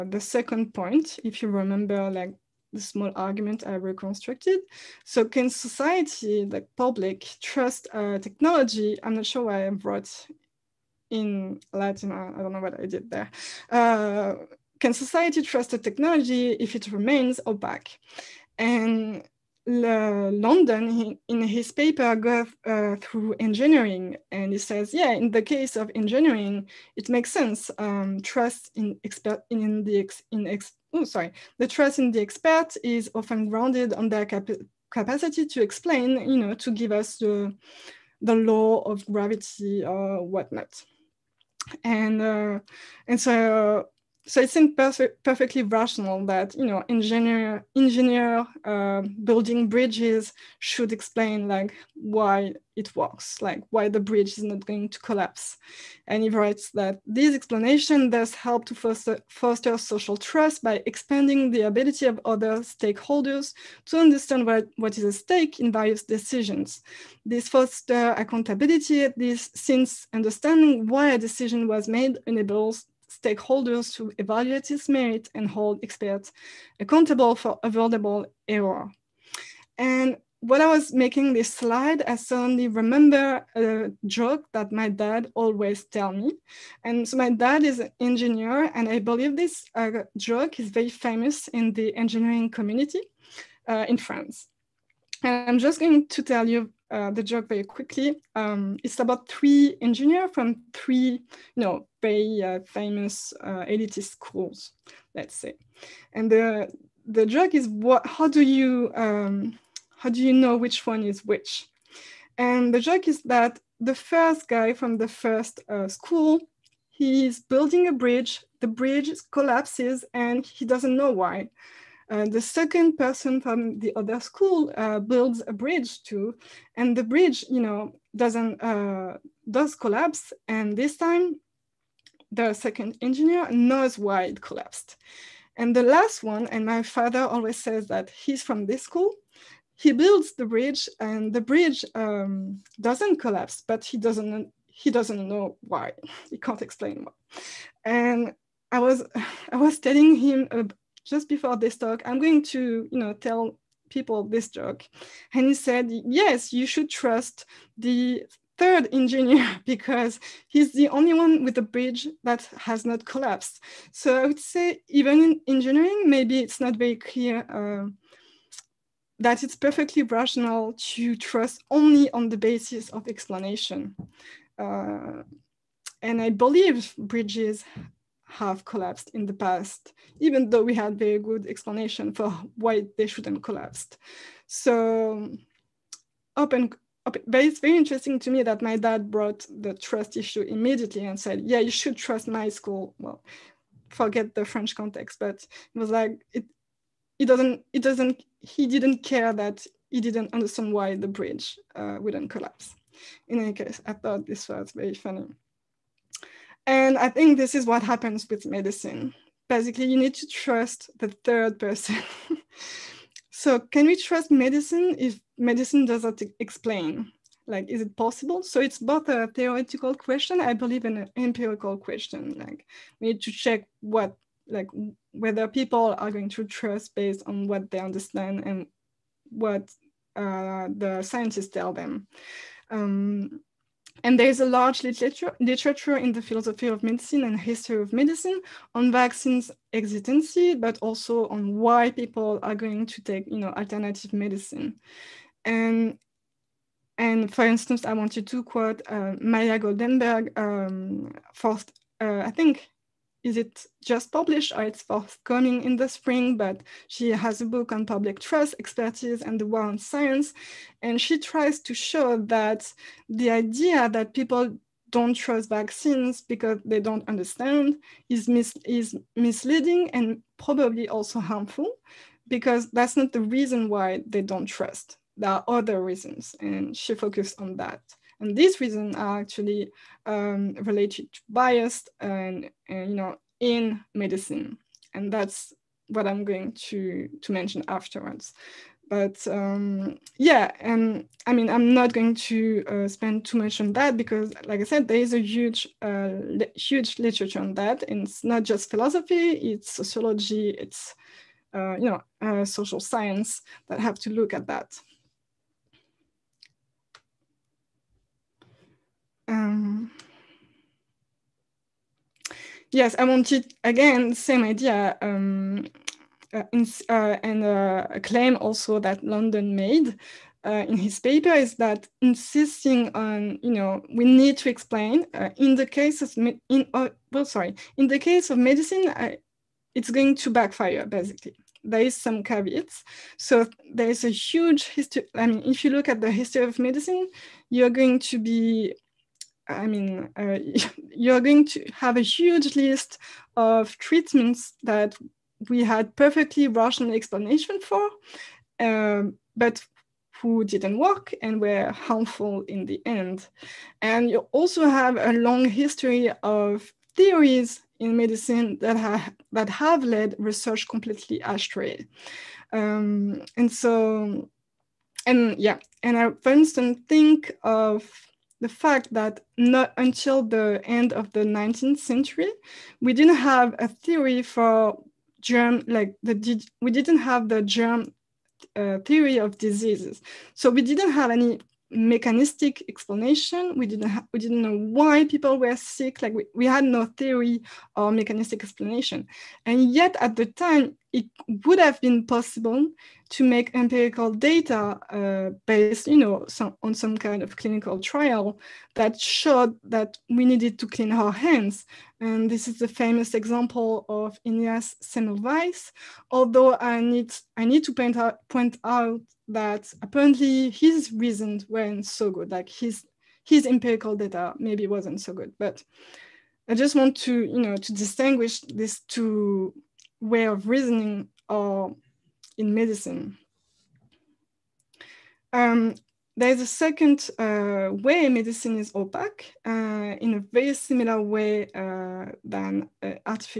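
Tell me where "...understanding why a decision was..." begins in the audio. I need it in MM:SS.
01:10.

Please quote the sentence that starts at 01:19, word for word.
And when I was making this slide, I suddenly remember a joke that my dad always tell me.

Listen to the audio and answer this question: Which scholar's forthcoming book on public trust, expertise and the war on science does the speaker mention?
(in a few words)
Maya Goldenberg.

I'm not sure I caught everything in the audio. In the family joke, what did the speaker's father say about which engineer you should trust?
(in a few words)
The third engineer.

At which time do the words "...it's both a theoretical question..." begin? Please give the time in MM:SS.
03:38.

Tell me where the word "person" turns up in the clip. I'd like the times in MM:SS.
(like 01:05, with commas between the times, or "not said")
02:02, 03:31.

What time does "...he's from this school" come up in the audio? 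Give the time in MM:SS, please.
02:18.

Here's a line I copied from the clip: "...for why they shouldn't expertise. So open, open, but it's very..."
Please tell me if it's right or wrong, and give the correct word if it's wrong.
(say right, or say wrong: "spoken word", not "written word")
wrong: "collapse", not "expertise".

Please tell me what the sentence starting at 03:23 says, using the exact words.
In any case, I thought this was very funny.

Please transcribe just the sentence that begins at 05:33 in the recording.
So there is a huge history.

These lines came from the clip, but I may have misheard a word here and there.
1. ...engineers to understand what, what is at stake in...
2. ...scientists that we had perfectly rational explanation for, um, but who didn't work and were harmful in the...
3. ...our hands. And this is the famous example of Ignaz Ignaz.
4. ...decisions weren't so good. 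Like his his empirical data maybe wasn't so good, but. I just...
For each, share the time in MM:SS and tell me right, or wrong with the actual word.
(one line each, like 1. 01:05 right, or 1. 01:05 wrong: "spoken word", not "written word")
1. 01:02 wrong: "stakeholders", not "engineers"
2. 05:43 wrong: "treatments", not "scientists"
3. 06:40 wrong: "Semmelweis", not "Ignaz"
4. 06:50 wrong: "reasons", not "decisions".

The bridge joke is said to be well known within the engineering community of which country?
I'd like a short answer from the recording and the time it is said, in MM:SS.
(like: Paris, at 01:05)
France, at 01:33.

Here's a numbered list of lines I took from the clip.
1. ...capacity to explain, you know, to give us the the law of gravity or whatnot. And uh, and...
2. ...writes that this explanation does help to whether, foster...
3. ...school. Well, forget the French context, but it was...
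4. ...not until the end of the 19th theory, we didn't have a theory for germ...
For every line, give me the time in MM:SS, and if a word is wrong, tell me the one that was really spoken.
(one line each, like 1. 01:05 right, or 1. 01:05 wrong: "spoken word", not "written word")
1. 00:34 right
2. 00:56 wrong: "foster", not "whether"
3. 03:12 right
4. 06:09 wrong: "century", not "theory".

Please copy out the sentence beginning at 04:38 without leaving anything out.
And these reasons are actually um, related to bias and, and, you know, in medicine.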